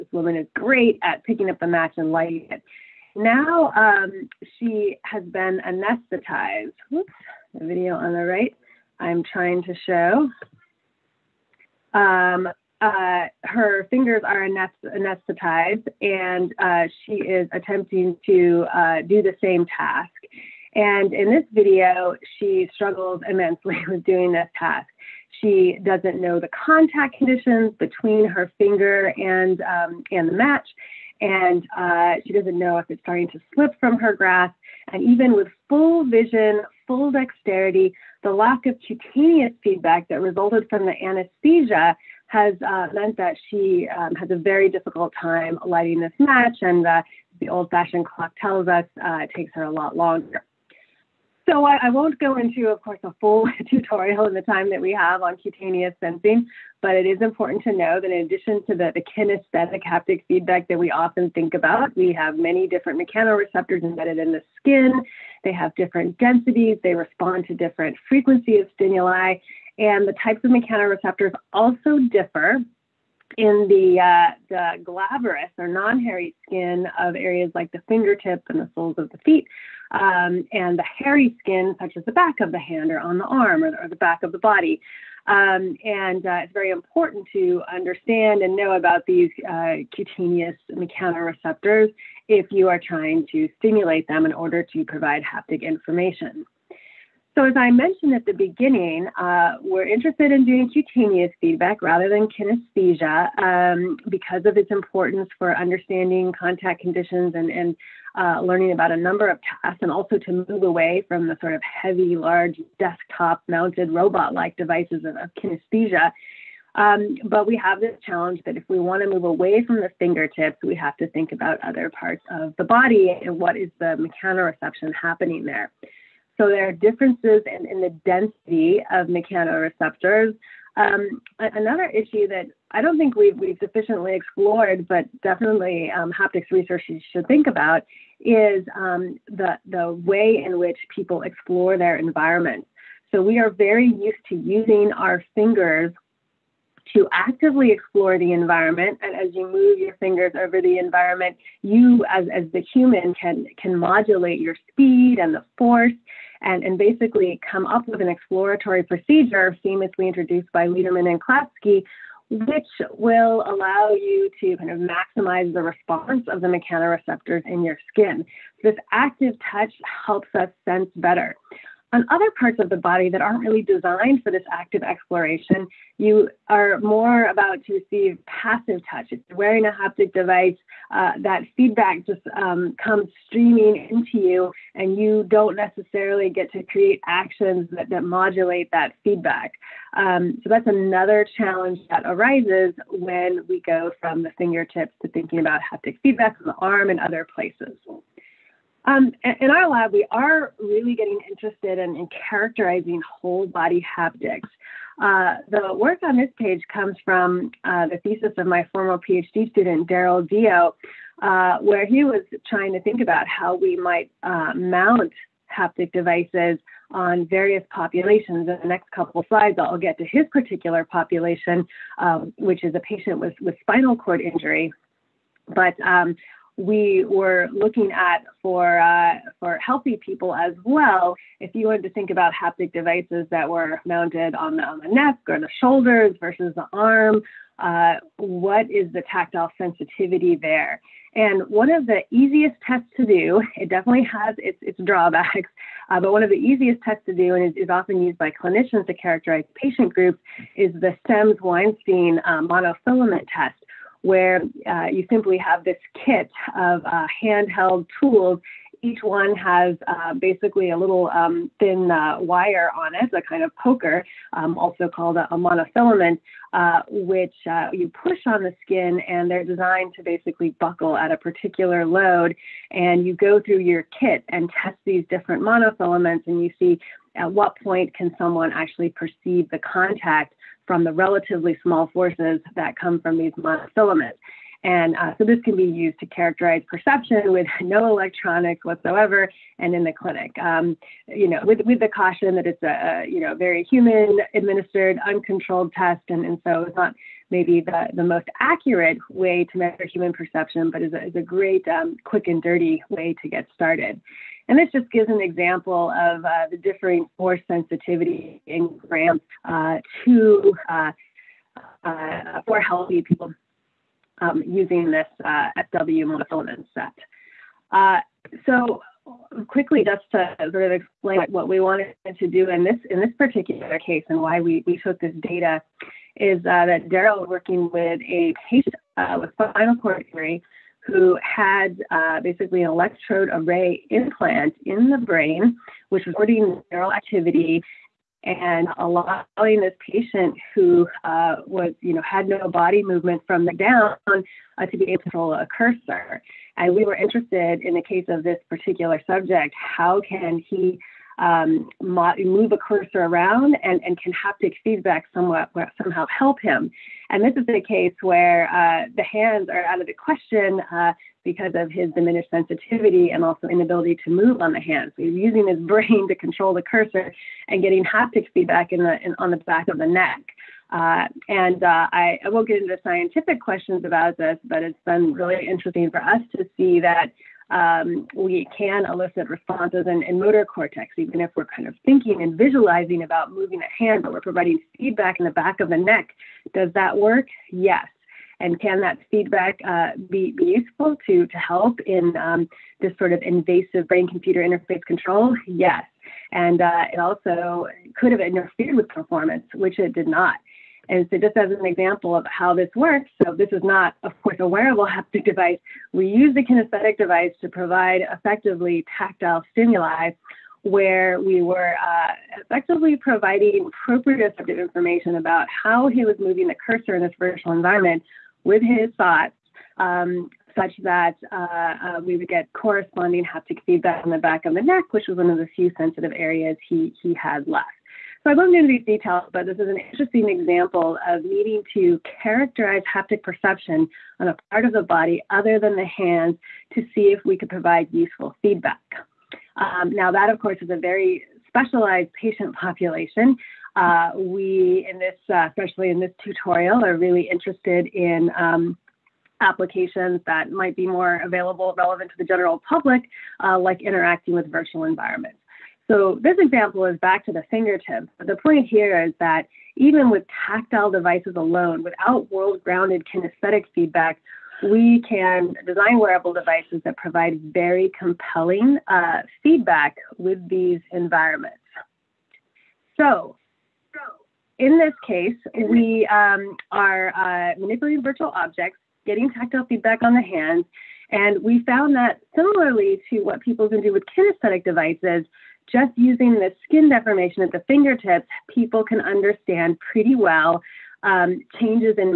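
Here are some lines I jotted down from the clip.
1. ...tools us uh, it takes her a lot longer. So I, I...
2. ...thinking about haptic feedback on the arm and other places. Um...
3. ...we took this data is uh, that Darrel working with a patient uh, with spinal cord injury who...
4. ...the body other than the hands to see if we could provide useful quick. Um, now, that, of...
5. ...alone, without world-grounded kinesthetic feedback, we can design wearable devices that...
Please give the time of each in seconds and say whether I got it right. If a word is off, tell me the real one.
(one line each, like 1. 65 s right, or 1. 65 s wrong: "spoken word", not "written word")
1. 48 s wrong: "tells", not "tools"
2. 195 s right
3. 324 s right
4. 434 s wrong: "feedback", not "quick"
5. 461 s right.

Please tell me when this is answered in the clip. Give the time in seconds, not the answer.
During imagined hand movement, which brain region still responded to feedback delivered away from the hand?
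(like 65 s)
380 s.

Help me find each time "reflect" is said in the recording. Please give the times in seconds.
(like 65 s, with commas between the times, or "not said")
not said.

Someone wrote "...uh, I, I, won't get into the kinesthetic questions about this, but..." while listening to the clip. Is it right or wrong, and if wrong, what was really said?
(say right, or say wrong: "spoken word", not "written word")
wrong: "scientific", not "kinesthetic".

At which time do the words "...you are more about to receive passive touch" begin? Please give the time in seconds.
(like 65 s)
175 s.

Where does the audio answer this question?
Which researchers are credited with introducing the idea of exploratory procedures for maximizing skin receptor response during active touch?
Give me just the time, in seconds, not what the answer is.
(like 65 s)
160 s.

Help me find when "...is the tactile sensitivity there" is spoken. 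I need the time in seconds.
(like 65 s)
238 s.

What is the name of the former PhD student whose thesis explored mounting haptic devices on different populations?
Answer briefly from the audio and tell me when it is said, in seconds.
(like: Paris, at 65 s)
Darrel Deo, at 209 s.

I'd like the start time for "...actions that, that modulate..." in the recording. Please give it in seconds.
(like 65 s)
187 s.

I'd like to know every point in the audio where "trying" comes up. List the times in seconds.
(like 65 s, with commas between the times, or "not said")
9 s, 92 s, 212 s.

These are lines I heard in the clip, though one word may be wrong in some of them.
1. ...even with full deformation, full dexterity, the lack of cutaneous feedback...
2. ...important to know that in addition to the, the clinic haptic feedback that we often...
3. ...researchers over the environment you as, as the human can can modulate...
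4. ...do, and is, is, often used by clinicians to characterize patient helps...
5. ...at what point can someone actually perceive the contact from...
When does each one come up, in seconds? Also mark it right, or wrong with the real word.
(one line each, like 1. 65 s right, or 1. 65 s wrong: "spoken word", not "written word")
1. 35 s wrong: "vision", not "deformation"
2. 57 s wrong: "kinesthetic", not "clinic"
3. 149 s wrong: "fingers", not "researchers"
4. 247 s wrong: "groups", not "helps"
5. 277 s right.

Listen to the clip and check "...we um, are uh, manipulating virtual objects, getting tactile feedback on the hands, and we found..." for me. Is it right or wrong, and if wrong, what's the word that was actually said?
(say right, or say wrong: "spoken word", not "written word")
right.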